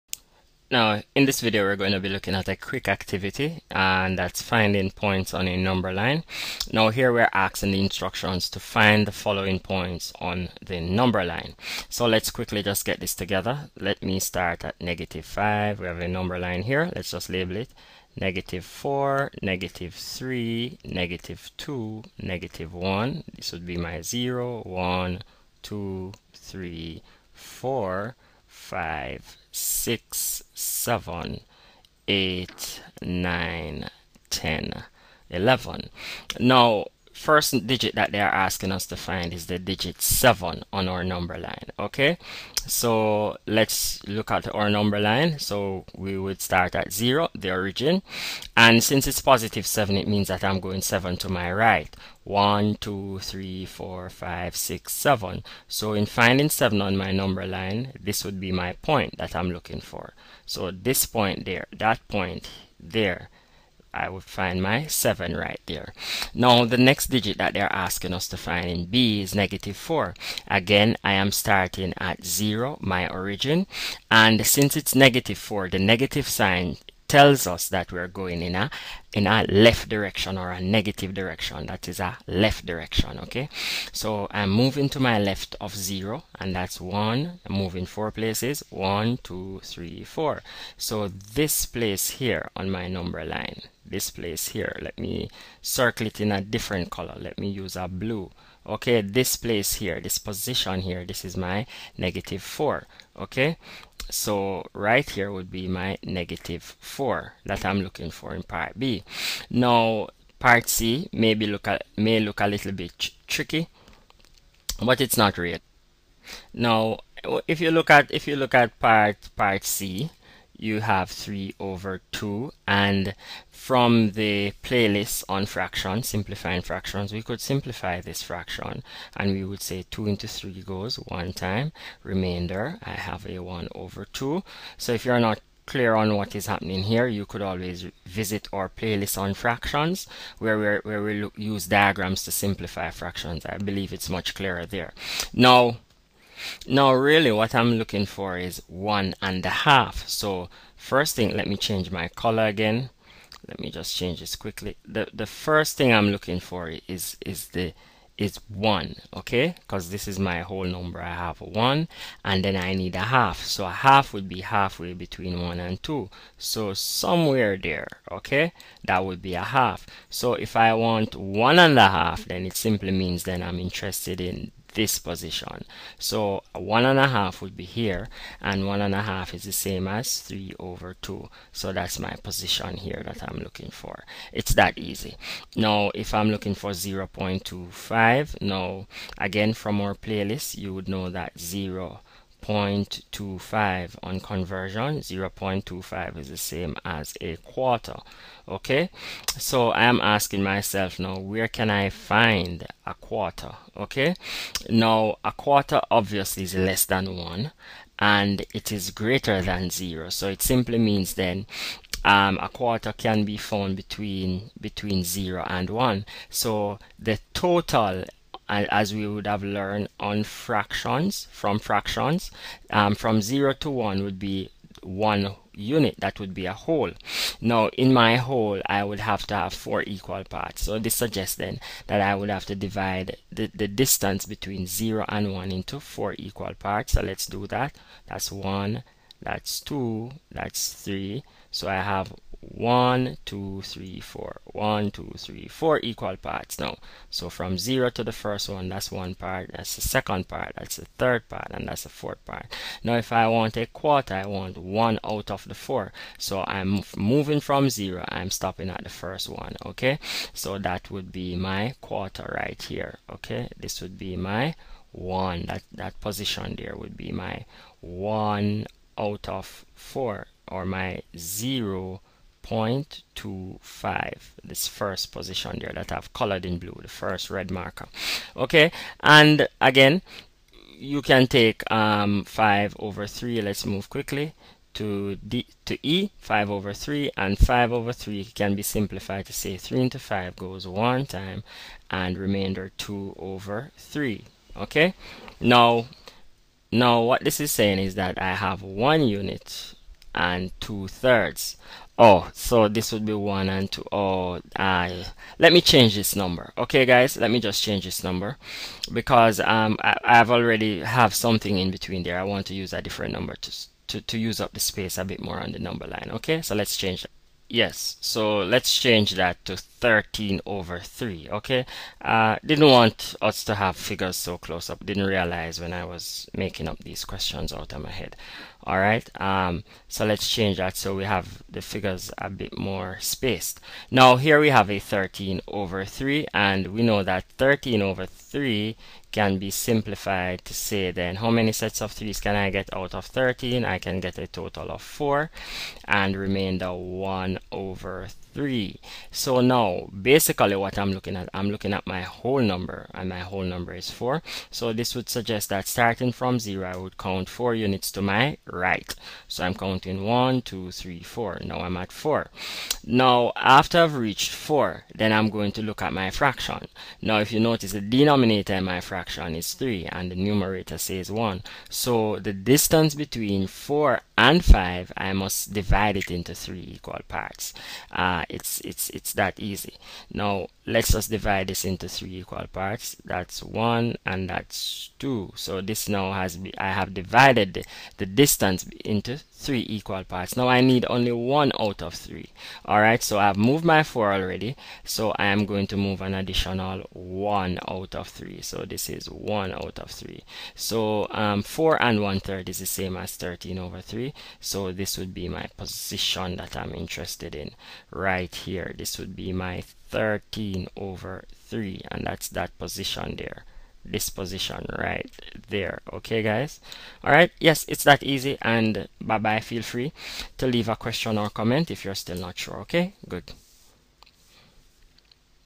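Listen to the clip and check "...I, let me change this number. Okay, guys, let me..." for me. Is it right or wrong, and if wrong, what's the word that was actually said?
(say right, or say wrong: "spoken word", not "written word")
right.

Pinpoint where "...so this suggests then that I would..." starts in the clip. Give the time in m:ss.
3:50.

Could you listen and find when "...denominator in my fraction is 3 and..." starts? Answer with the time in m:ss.
6:07.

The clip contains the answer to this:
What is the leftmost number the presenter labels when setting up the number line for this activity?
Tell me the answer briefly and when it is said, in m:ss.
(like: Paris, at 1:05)
-5, at 0:14.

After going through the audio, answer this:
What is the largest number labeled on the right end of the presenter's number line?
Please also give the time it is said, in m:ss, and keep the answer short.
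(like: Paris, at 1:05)
11, at 0:35.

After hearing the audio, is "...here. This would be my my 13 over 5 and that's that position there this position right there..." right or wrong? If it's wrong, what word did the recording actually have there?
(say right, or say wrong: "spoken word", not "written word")
wrong: "3", not "5".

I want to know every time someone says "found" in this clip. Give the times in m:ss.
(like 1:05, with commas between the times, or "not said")
3:33.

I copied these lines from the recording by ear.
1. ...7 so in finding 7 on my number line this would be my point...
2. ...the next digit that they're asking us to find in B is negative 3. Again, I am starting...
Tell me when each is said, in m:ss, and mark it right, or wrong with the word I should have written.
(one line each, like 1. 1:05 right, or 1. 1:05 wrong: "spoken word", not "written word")
1. 0:54 right
2. 1:06 wrong: "4", not "3".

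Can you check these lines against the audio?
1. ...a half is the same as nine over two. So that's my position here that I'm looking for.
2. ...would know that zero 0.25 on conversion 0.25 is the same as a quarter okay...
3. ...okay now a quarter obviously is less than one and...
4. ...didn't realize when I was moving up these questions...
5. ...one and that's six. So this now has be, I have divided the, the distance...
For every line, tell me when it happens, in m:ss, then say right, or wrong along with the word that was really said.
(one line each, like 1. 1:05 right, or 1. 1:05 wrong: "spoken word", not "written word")
1. 2:58 wrong: "three", not "nine"
2. 3:10 right
3. 3:23 right
4. 5:24 wrong: "making", not "moving"
5. 6:23 wrong: "two", not "six".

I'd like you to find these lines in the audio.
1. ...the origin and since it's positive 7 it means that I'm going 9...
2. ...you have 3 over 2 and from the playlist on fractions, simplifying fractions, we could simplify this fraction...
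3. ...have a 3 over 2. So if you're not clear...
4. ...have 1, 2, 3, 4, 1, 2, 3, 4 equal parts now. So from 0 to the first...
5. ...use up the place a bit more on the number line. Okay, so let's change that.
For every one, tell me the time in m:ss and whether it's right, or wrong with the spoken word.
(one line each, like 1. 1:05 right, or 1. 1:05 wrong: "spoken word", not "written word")
1. 0:47 wrong: "7", not "9"
2. 2:00 right
3. 2:12 wrong: "1", not "3"
4. 4:01 right
5. 5:14 wrong: "space", not "place".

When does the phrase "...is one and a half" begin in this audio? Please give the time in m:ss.
2:28.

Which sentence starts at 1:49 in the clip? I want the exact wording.
Now part C maybe look may look a little bit tricky, but it's not real.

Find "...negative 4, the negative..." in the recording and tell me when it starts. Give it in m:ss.
1:14.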